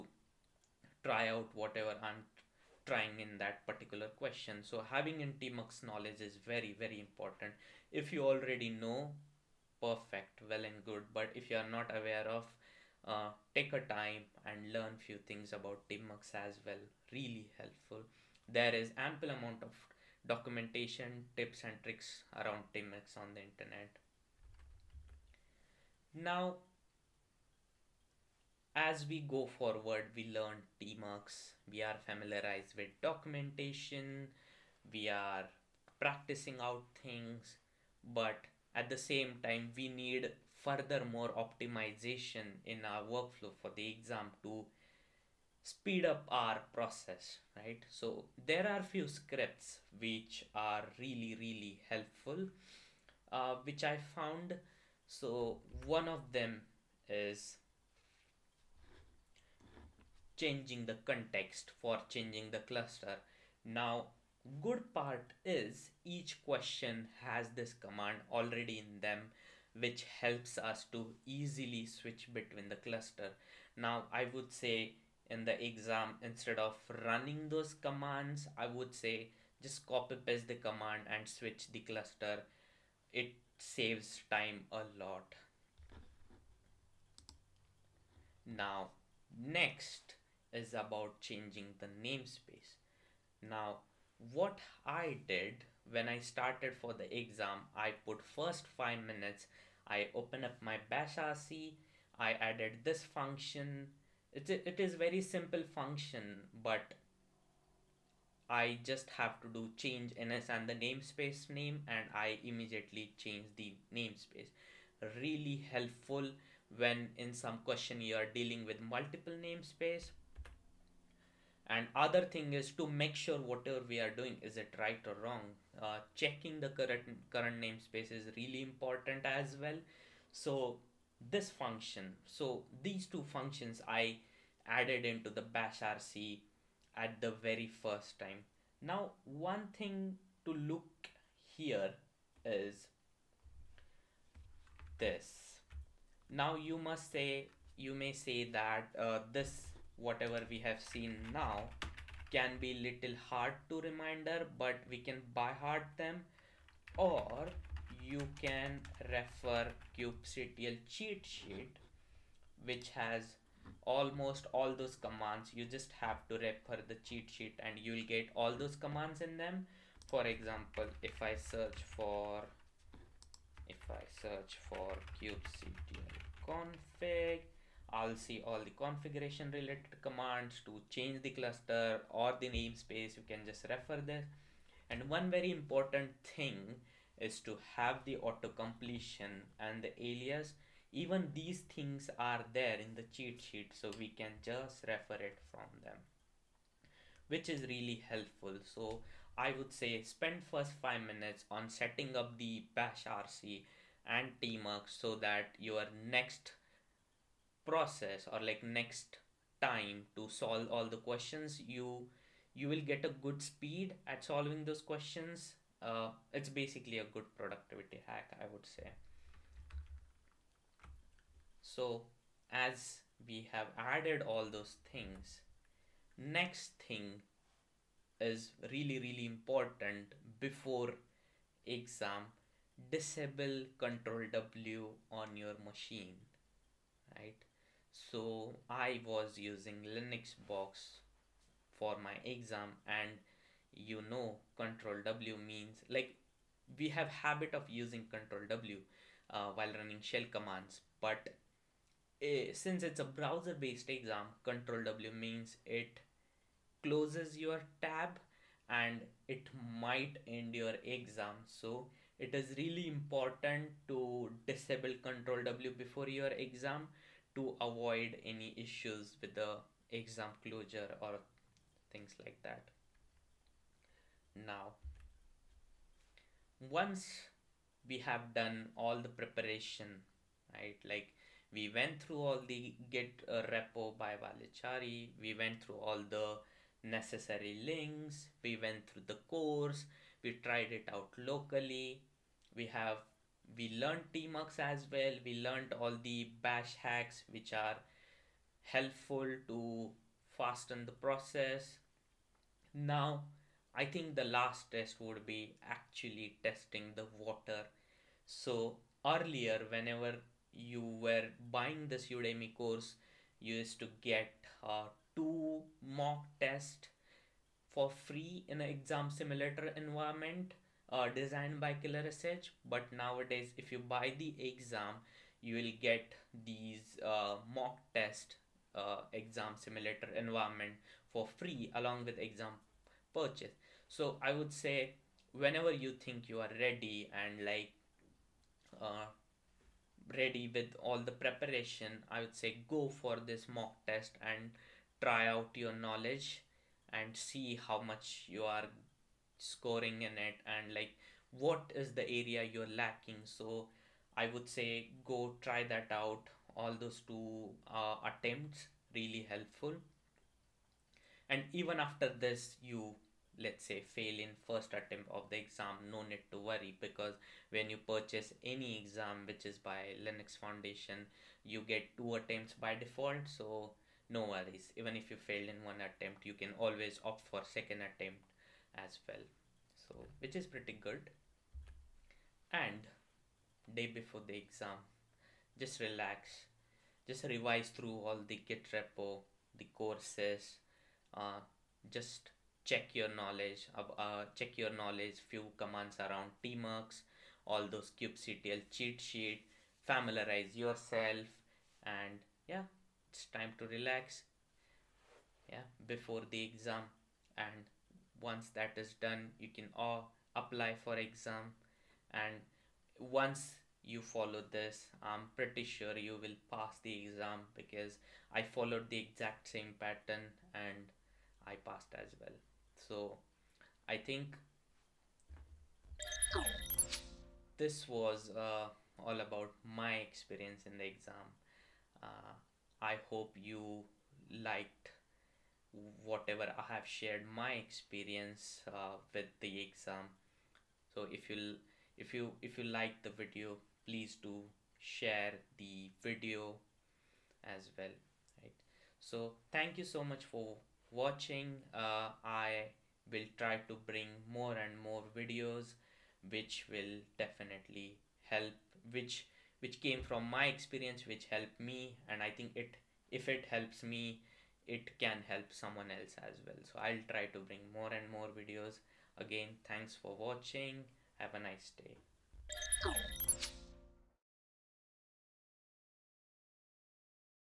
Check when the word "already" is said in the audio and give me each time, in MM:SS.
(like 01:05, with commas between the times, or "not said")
00:08, 01:08.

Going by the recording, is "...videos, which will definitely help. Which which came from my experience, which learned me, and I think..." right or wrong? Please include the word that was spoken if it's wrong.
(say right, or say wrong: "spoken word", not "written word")
wrong: "helped", not "learned".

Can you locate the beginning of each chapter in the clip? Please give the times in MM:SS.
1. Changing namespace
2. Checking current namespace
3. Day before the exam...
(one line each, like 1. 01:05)
1. 01:27
2. 02:00
3. 06:21.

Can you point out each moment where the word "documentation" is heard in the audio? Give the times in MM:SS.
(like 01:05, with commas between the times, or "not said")
00:20, 00:33.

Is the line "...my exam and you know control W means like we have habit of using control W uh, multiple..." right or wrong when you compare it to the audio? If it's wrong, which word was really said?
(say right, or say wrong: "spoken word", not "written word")
wrong: "while", not "multiple".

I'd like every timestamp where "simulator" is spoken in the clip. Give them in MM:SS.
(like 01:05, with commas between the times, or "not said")
05:19, 05:29.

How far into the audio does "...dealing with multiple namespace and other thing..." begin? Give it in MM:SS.
01:58.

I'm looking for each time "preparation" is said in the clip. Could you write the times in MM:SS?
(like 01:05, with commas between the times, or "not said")
04:39, 05:41.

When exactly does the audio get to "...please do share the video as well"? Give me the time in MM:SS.
07:23.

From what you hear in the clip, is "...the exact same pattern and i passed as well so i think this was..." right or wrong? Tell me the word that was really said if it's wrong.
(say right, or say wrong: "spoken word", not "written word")
right.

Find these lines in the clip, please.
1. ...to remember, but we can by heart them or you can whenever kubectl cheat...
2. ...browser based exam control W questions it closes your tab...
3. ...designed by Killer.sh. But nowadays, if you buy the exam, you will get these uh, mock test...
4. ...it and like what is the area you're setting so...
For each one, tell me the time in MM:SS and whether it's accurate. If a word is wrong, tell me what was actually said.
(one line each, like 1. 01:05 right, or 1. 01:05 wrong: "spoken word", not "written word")
1. 02:33 wrong: "refer", not "whenever"
2. 04:13 wrong: "means", not "questions"
3. 05:21 right
4. 05:50 wrong: "lacking", not "setting".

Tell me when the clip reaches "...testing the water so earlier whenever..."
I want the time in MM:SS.
05:06.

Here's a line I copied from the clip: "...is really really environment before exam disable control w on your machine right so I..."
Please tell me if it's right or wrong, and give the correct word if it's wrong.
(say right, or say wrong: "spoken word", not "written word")
wrong: "important", not "environment".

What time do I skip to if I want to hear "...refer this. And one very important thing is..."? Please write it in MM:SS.
03:03.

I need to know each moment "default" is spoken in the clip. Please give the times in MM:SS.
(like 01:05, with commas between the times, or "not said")
06:12.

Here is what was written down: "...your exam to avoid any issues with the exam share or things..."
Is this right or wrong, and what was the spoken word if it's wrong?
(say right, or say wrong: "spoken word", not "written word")
wrong: "closure", not "share".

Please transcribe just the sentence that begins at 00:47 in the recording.
So there are few scripts which are really, really helpful, uh, which I found.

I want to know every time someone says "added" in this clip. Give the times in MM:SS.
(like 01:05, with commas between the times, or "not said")
01:42, 02:14, 03:43.